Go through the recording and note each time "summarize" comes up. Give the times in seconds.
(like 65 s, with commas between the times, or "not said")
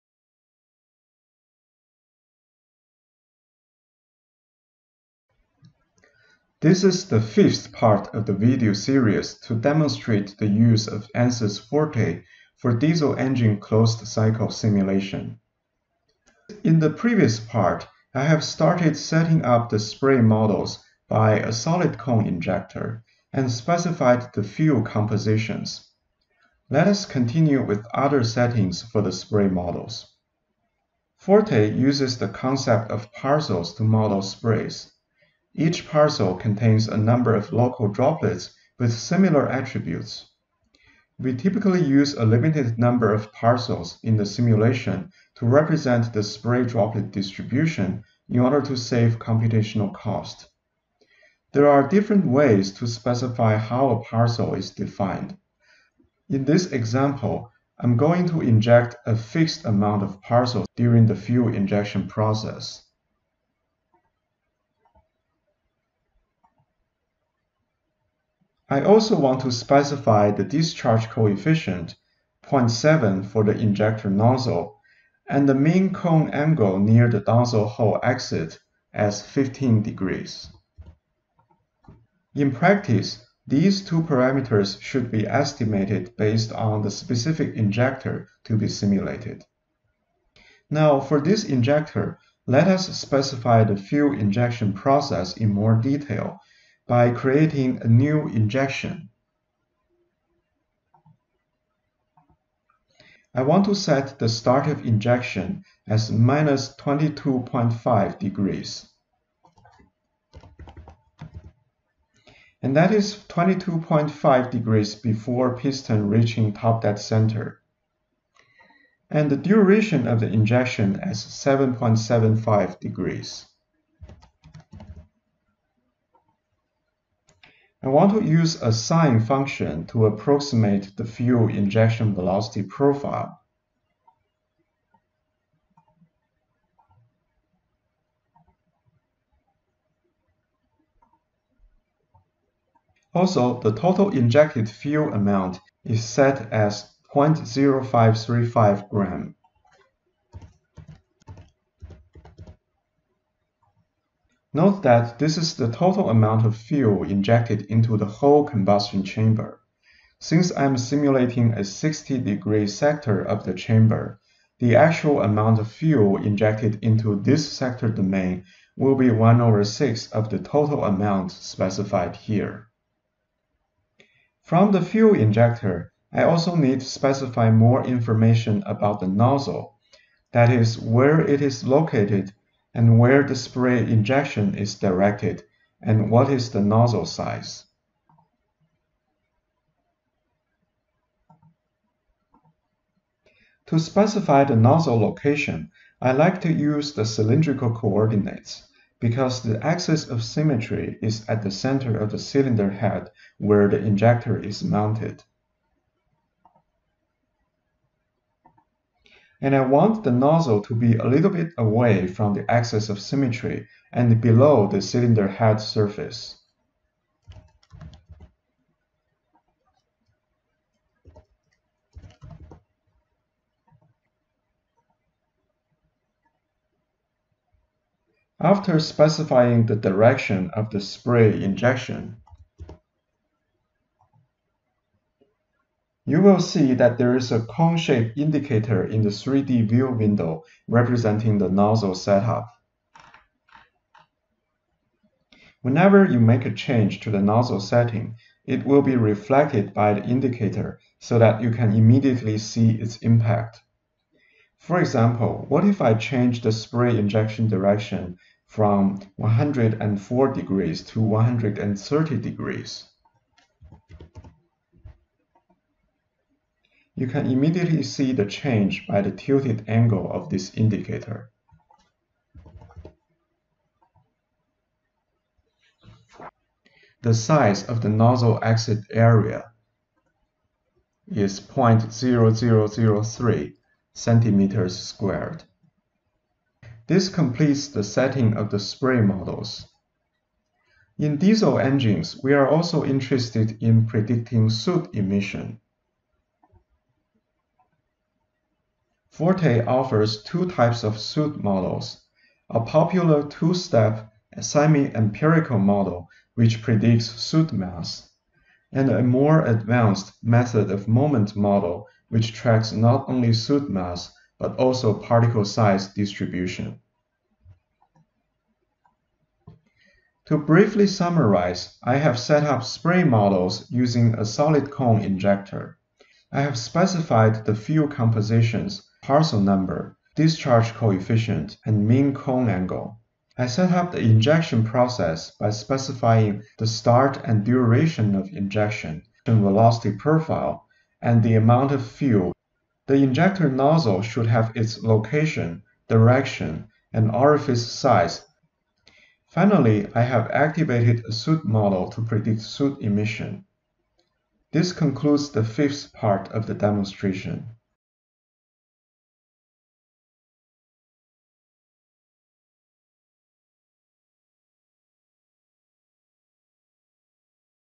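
320 s.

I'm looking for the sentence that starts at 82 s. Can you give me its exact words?
In practice, these two parameters should be estimated based on the specific injector to be simulated.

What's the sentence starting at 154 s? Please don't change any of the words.
Note that this is the total amount of fuel injected into the whole combustion chamber.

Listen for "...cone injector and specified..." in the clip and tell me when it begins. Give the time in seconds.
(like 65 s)
21 s.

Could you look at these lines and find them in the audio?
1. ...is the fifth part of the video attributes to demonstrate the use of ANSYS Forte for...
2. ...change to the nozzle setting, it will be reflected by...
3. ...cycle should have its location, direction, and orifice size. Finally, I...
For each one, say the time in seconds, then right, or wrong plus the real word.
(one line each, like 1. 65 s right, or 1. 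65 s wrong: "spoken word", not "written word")
1. 6 s wrong: "series", not "attributes"
2. 246 s right
3. 343 s wrong: "nozzle", not "cycle".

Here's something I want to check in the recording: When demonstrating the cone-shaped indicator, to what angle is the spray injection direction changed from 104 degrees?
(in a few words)
130 degrees.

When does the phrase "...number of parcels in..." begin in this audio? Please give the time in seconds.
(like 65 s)
42 s.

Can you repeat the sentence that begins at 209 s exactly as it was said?
and I want the nozzle to be a little bit away from the axis of symmetry and below the cylinder head surface.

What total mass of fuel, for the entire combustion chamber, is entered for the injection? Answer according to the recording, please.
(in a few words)
0.0535 gram.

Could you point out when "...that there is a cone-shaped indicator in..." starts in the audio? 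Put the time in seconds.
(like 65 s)
236 s.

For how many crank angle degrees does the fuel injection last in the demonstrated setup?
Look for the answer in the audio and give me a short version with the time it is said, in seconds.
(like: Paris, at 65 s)
7.75 degrees, at 121 s.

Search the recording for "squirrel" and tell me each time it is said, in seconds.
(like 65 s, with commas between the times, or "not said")
not said.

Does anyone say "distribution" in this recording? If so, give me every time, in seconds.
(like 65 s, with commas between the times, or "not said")
47 s, 315 s.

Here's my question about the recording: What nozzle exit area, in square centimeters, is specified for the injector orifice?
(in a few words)
0.0003.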